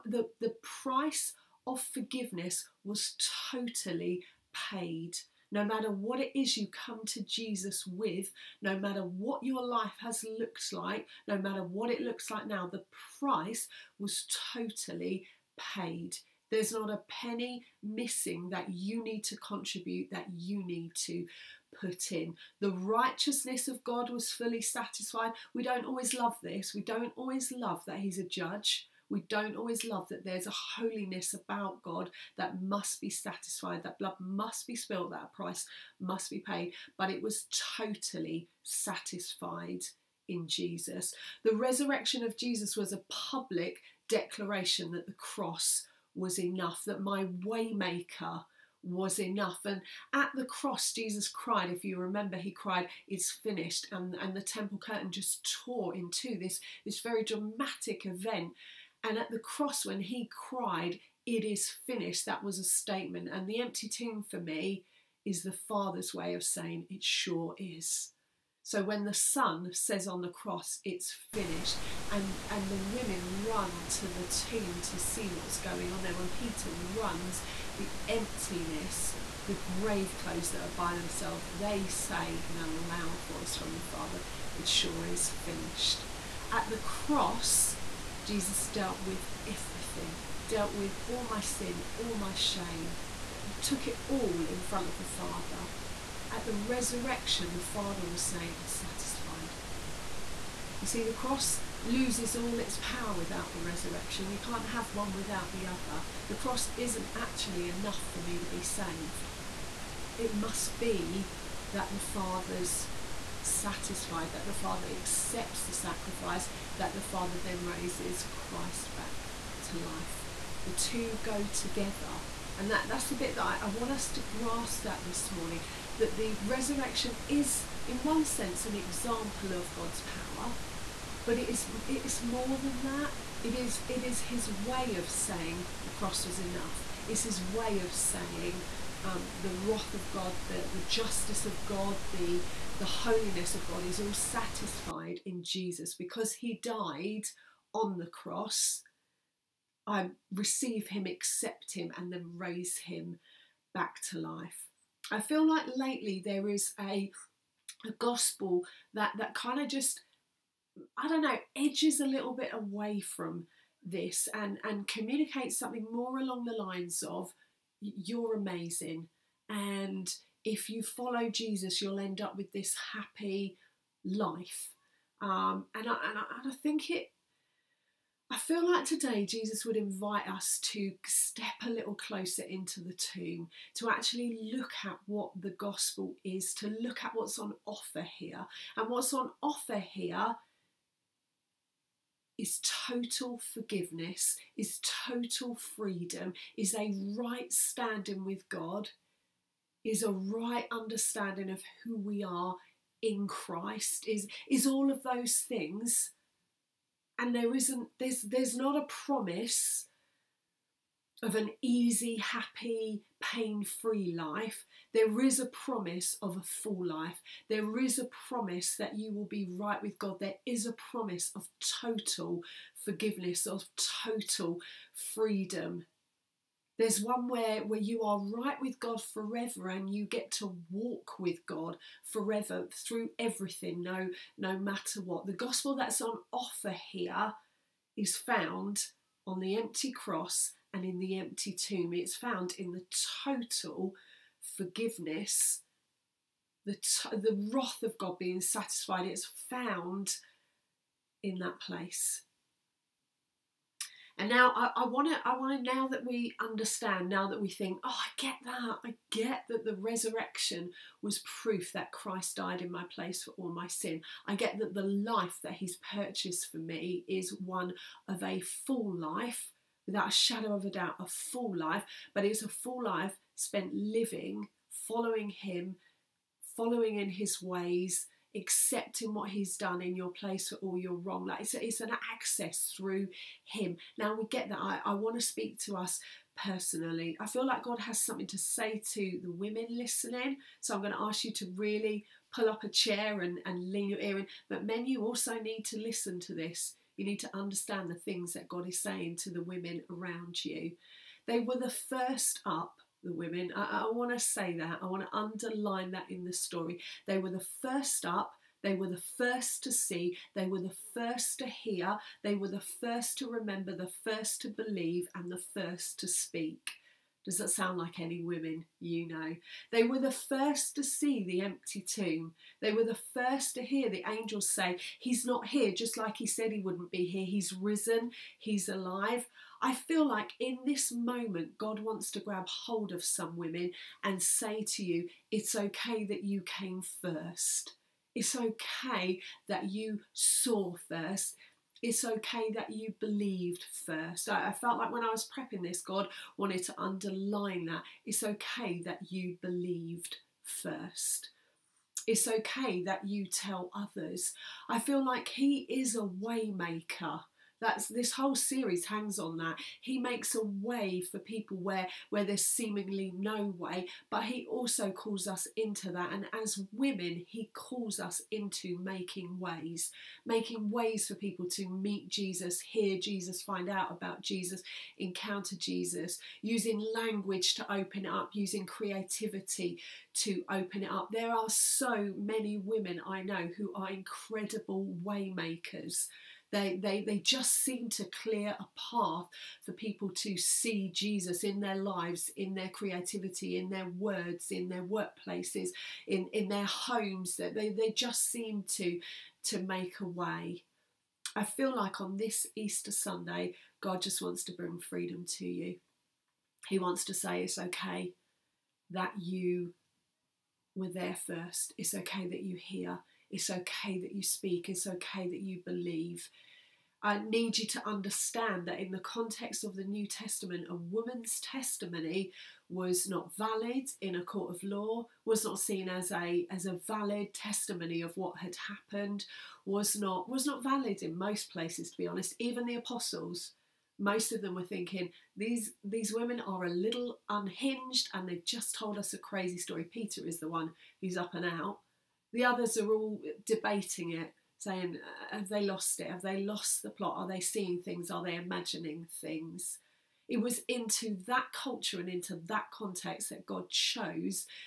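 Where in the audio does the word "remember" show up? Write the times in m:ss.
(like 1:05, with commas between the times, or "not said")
0:51, 5:13.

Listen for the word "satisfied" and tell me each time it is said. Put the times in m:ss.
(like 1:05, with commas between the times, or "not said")
0:24, 0:33, 0:38, 1:38, 1:53, 2:24, 4:08.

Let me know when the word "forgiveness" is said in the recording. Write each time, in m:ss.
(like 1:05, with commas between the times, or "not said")
0:01, 3:13, 3:42, 4:04.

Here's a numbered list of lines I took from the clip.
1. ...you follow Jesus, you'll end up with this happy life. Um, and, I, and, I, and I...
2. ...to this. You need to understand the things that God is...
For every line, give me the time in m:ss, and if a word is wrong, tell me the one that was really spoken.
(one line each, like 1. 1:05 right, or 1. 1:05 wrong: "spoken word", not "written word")
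1. 2:50 right
2. 4:56 right.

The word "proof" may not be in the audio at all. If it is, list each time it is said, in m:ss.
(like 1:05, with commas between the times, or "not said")
4:21.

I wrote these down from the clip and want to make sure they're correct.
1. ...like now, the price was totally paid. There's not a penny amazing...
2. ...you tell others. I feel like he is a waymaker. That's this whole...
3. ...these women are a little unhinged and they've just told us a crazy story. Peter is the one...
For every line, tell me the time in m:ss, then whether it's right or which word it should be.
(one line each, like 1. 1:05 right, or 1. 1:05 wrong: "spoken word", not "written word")
1. 0:12 wrong: "missing", not "amazing"
2. 5:53 right
3. 7:15 right.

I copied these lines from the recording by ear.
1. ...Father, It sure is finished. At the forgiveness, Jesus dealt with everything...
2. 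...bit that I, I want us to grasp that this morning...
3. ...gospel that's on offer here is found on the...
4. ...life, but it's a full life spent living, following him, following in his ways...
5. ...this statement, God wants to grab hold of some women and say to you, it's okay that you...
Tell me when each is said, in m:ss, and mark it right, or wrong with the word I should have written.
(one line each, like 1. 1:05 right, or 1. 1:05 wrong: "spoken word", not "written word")
1. 1:23 wrong: "cross", not "forgiveness"
2. 2:03 right
3. 3:55 right
4. 4:31 right
5. 5:30 wrong: "moment", not "statement".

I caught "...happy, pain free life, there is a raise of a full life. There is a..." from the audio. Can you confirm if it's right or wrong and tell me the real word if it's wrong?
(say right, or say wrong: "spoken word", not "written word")
wrong: "promise", not "raise".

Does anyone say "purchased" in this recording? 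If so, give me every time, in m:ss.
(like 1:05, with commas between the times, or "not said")
4:25.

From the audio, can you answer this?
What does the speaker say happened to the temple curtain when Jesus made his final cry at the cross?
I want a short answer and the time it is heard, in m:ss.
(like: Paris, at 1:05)
tore in two, at 0:55.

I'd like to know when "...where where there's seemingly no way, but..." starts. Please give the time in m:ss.
6:01.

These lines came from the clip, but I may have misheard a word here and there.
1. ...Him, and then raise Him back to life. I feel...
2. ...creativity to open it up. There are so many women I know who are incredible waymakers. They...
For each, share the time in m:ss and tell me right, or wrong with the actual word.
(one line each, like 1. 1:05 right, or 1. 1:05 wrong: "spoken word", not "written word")
1. 2:31 right
2. 6:18 right.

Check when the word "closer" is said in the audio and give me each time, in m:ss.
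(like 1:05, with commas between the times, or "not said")
3:01.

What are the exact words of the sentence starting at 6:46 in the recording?
He wants to say it's okay that you were there first.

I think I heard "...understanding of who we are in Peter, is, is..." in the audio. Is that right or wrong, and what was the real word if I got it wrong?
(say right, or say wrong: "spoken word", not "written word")
wrong: "Christ", not "Peter".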